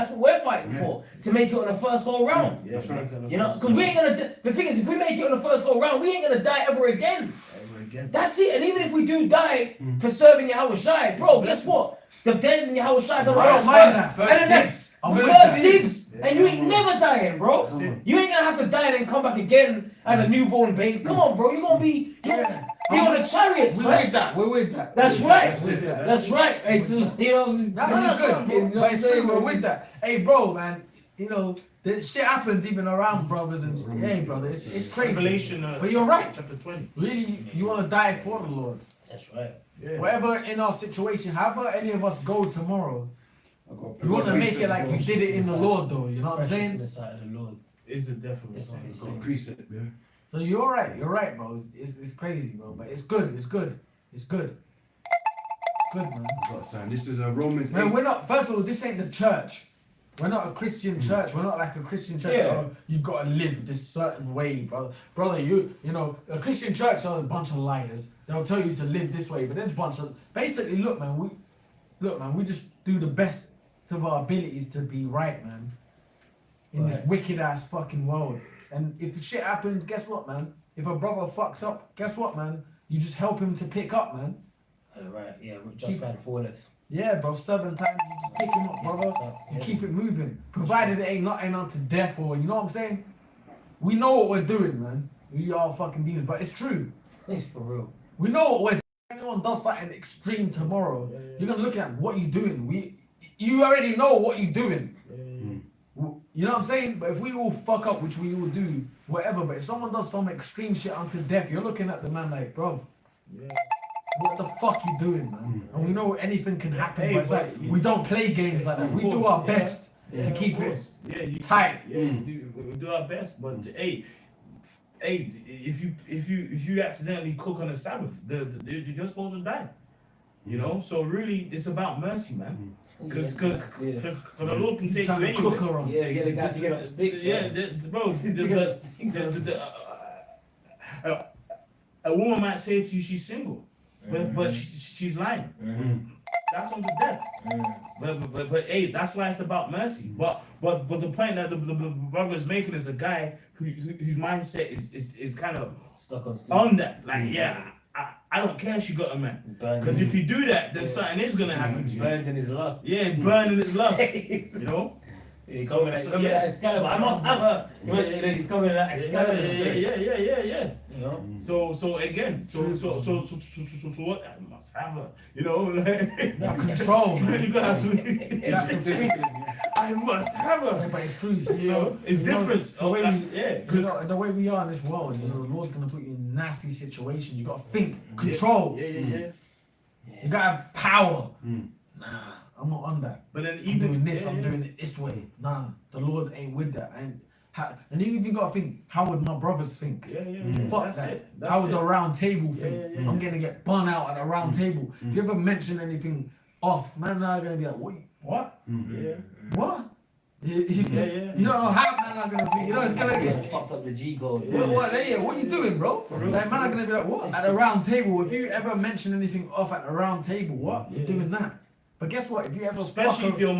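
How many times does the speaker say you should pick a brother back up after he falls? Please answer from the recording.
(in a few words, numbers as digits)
7.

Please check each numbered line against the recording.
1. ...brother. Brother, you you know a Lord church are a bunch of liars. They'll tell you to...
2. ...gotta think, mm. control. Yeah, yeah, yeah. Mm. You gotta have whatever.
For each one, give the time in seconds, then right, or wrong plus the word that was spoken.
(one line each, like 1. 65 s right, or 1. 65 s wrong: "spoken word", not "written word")
1. 64 s wrong: "Christian", not "Lord"
2. 187 s wrong: "power", not "whatever".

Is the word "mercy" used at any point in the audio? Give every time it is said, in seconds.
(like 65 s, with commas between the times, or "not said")
132 s, 149 s.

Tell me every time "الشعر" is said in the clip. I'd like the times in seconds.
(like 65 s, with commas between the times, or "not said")
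12 s.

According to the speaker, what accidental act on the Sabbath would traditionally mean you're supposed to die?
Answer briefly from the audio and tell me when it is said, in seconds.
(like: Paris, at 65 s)
cook, at 127 s.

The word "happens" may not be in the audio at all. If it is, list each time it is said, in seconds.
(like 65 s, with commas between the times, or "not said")
32 s, 79 s, 116 s, 161 s.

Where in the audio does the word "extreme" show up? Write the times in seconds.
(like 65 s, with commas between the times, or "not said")
99 s, 110 s.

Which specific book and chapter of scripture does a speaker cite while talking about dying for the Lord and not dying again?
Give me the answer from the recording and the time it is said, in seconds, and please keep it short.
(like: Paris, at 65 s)
Revelation chapter 20, at 35 s.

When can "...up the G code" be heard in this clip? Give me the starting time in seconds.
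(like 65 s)
213 s.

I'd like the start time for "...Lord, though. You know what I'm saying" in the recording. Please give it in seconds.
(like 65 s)
45 s.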